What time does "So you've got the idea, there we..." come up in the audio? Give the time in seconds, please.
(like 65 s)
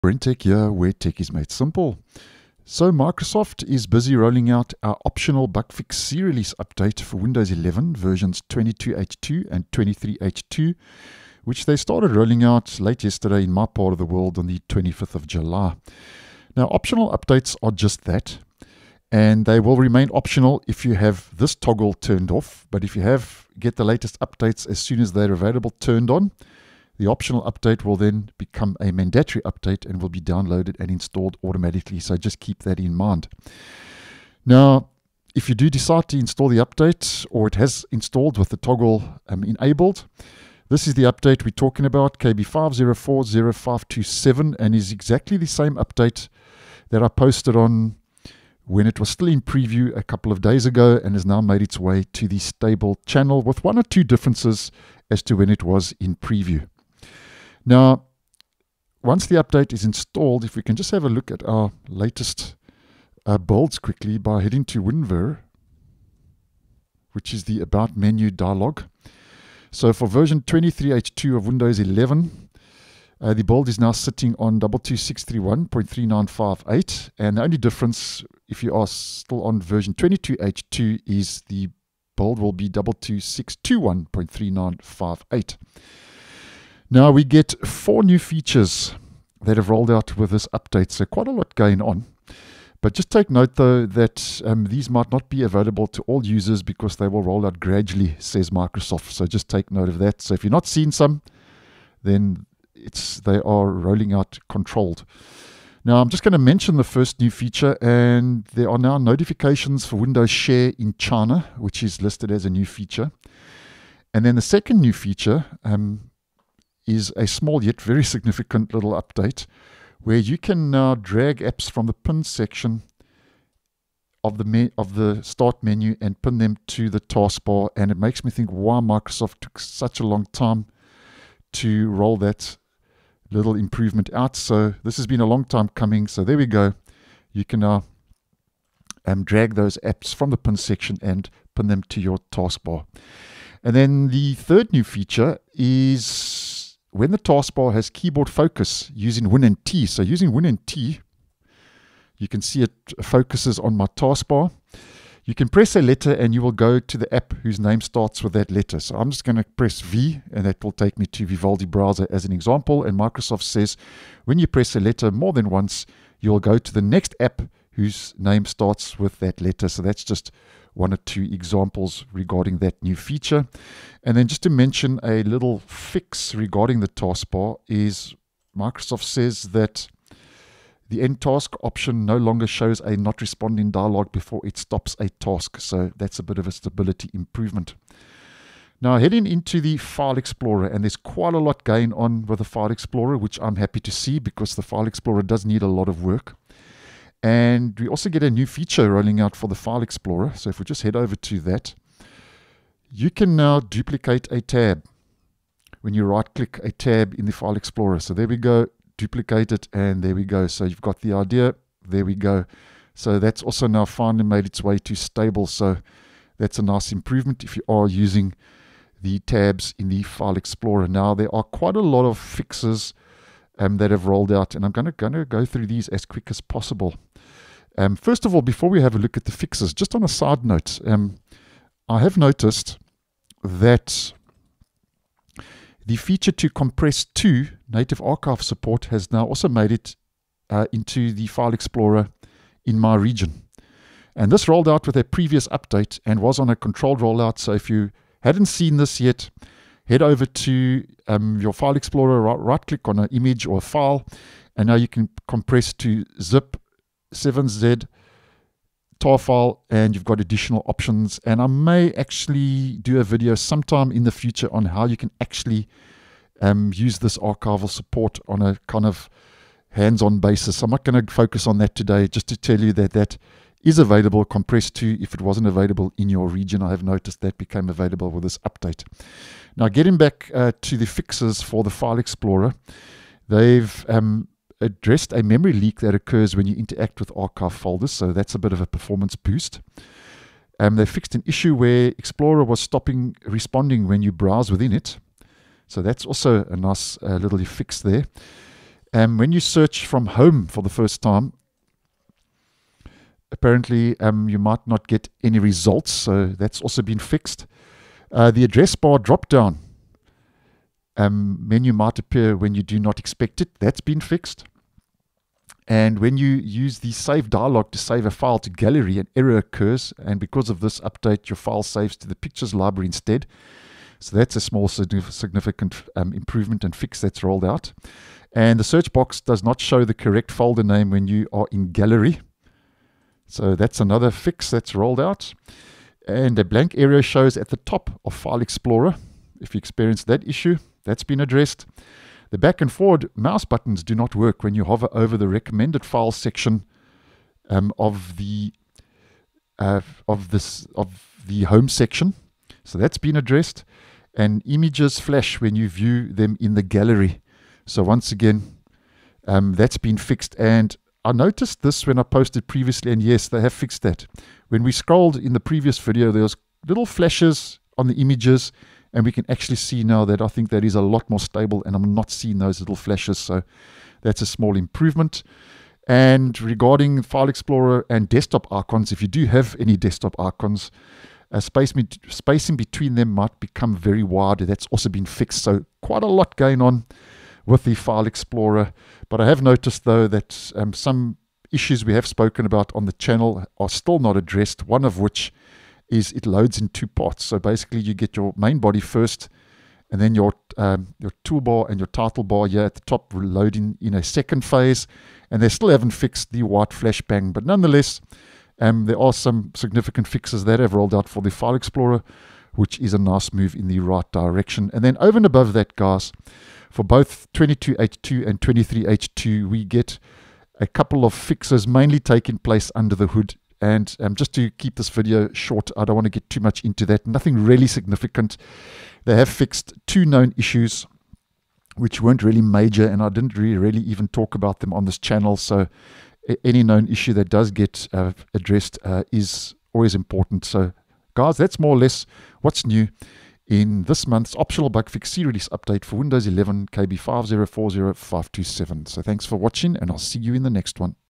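210 s.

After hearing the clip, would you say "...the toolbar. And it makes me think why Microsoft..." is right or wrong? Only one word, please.
wrong.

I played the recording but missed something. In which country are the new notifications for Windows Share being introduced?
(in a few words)
China.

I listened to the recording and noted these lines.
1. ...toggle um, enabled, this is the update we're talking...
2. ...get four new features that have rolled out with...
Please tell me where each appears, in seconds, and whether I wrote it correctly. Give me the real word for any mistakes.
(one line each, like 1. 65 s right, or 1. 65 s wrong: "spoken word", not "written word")
1. 38 s right
2. 87 s right.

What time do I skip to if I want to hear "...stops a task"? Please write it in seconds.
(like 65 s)
184 s.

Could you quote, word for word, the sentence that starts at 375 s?
And regarding File Explorer and desktop icons, if you do have any desktop icons, space, spacing between them might become very wide.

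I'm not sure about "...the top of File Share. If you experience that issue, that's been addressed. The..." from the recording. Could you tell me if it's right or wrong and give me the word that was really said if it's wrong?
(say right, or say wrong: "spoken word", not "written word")
wrong: "Explorer", not "Share".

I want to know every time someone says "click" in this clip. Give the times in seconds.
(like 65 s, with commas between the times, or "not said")
206 s, 252 s.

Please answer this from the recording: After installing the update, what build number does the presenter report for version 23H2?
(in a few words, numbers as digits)
22631.3958.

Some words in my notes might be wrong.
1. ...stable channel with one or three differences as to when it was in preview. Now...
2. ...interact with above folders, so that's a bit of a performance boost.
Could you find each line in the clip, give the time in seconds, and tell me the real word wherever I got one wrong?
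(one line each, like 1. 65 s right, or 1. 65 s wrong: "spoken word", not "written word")
1. 52 s wrong: "two", not "three"
2. 286 s wrong: "archive", not "above".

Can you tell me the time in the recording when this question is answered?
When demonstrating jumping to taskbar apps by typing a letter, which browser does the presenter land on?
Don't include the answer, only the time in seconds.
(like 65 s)
161 s.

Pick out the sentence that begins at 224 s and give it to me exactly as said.
And I'm going to go through these as quick as possible.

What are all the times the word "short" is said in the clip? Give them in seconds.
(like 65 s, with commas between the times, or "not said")
425 s.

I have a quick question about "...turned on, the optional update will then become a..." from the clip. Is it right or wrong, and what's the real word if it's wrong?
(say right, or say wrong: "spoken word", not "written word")
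right.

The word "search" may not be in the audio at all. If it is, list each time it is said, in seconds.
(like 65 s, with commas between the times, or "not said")
299 s, 328 s.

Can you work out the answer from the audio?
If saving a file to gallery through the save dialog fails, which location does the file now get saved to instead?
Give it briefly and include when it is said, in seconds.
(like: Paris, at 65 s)
Pictures library, at 322 s.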